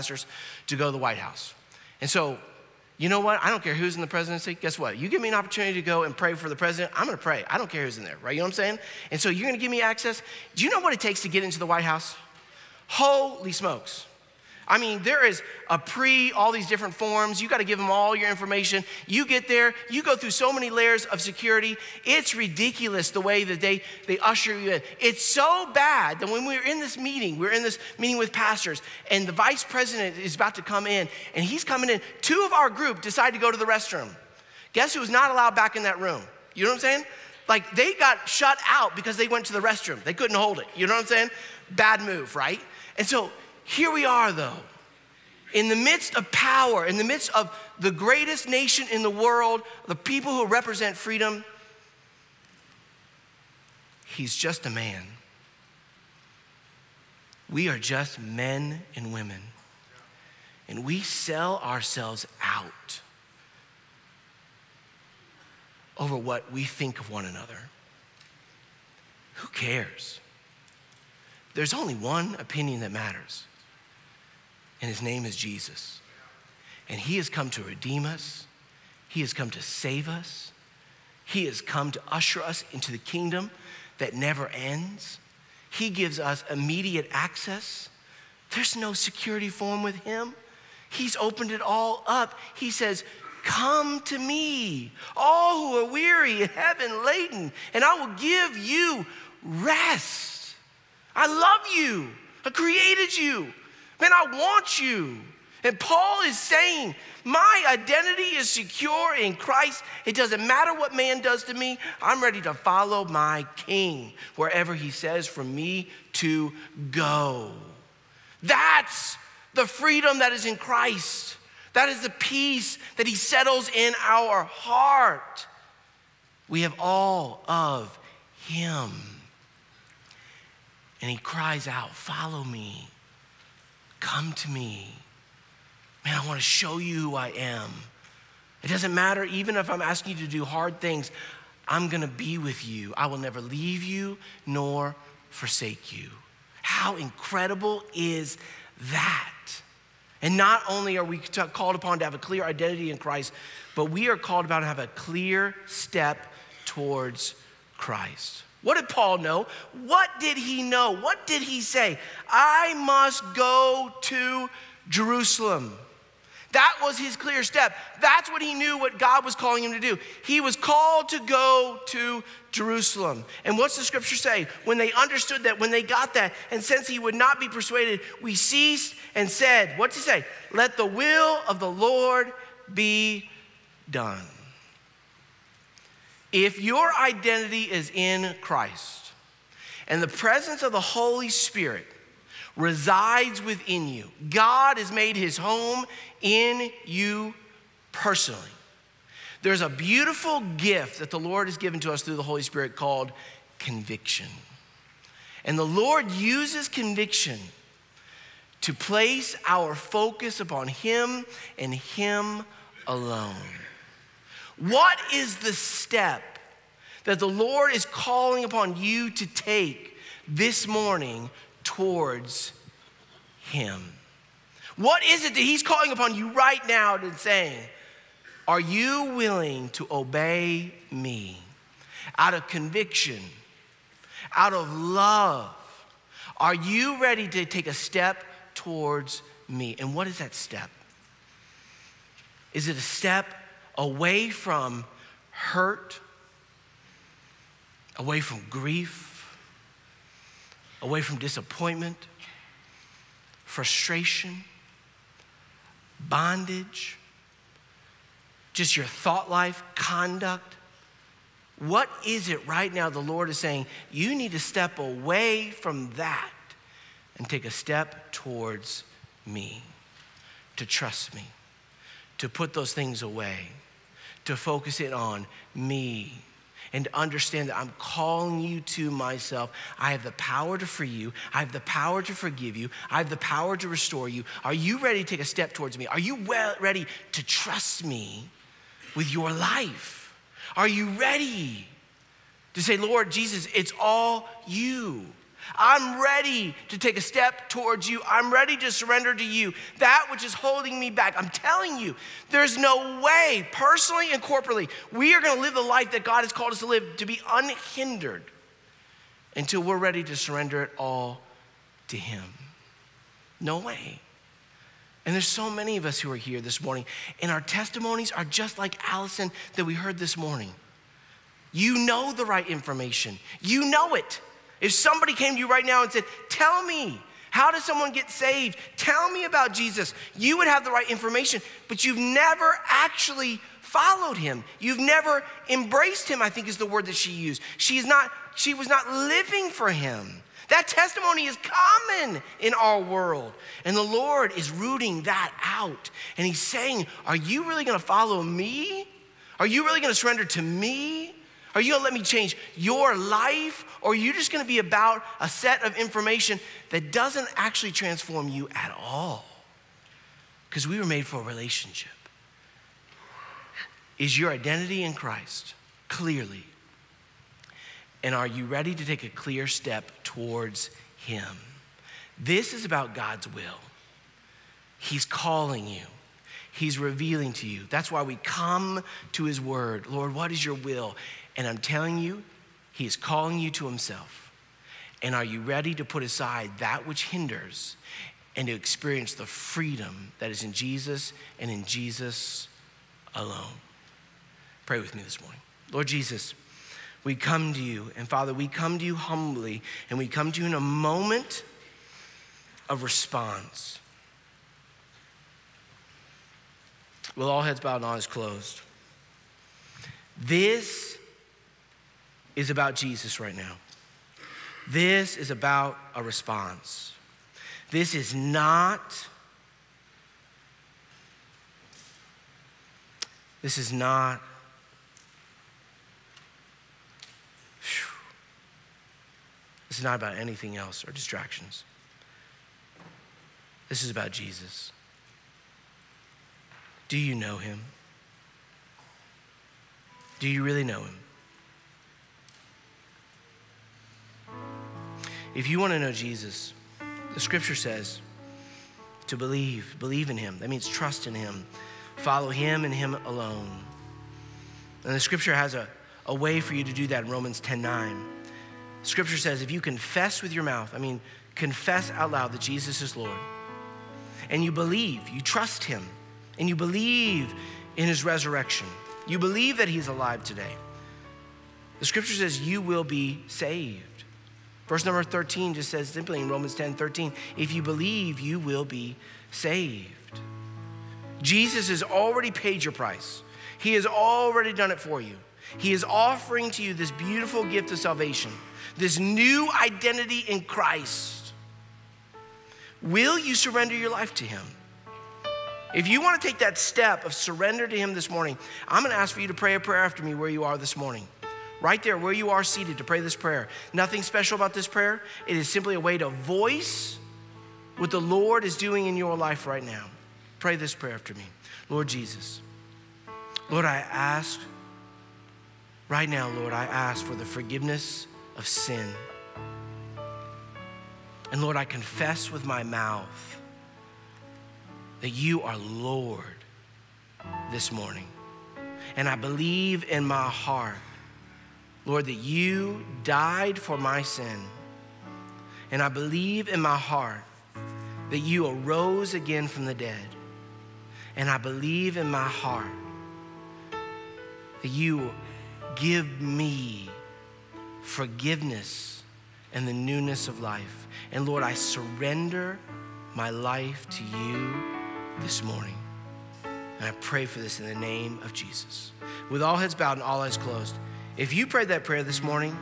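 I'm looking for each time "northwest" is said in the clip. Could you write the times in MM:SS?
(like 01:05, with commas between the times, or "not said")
not said.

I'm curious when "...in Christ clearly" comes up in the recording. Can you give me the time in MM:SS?
06:04.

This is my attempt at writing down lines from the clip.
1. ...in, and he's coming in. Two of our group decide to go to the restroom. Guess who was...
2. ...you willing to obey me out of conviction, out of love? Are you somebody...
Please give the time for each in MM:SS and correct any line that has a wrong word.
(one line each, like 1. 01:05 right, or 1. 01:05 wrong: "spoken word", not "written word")
1. 00:30 right
2. 03:48 wrong: "ready", not "somebody".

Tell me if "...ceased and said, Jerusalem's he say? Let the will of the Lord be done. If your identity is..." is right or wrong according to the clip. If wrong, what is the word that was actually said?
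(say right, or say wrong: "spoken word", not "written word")
wrong: "What", not "Jerusalem".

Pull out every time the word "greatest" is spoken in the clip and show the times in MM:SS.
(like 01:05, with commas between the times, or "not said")
00:47.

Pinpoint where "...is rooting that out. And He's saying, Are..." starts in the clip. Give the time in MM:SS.
05:44.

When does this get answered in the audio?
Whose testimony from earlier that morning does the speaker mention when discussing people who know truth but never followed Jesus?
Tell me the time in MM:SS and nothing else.
05:18.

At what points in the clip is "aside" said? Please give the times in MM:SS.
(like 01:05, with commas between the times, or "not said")
06:26.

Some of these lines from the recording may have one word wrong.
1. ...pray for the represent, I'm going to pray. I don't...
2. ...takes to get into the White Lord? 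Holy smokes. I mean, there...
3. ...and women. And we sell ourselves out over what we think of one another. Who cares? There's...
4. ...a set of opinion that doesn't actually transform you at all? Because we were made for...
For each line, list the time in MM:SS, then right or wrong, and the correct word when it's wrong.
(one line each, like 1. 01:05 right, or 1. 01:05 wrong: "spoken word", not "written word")
1. 00:06 wrong: "president", not "represent"
2. 00:10 wrong: "House", not "Lord"
3. 00:58 right
4. 05:55 wrong: "information", not "opinion".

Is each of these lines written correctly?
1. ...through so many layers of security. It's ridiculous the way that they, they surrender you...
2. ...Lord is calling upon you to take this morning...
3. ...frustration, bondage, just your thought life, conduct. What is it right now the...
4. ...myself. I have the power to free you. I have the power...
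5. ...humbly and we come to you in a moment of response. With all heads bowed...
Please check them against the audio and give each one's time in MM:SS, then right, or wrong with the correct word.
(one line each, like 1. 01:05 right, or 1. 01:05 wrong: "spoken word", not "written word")
1. 00:20 wrong: "usher", not "surrender"
2. 03:37 right
3. 04:13 right
4. 04:38 right
5. 06:38 right.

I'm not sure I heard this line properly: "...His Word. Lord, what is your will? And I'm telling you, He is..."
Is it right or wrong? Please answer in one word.
right.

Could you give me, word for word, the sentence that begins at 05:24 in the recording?
If somebody came to you right now and said, Tell me, how does someone get saved?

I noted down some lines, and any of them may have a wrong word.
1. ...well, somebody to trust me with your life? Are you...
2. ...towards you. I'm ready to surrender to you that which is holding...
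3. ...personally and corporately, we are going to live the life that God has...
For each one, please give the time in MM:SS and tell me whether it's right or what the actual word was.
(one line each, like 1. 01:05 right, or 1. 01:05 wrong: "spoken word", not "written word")
1. 04:46 wrong: "ready", not "somebody"
2. 04:57 right
3. 05:03 right.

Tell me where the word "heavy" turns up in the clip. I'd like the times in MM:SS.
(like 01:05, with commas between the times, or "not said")
01:36.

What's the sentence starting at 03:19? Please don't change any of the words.
There's a beautiful gift that the Lord has given to us through the Holy Spirit called conviction.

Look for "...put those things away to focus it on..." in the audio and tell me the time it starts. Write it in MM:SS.
04:32.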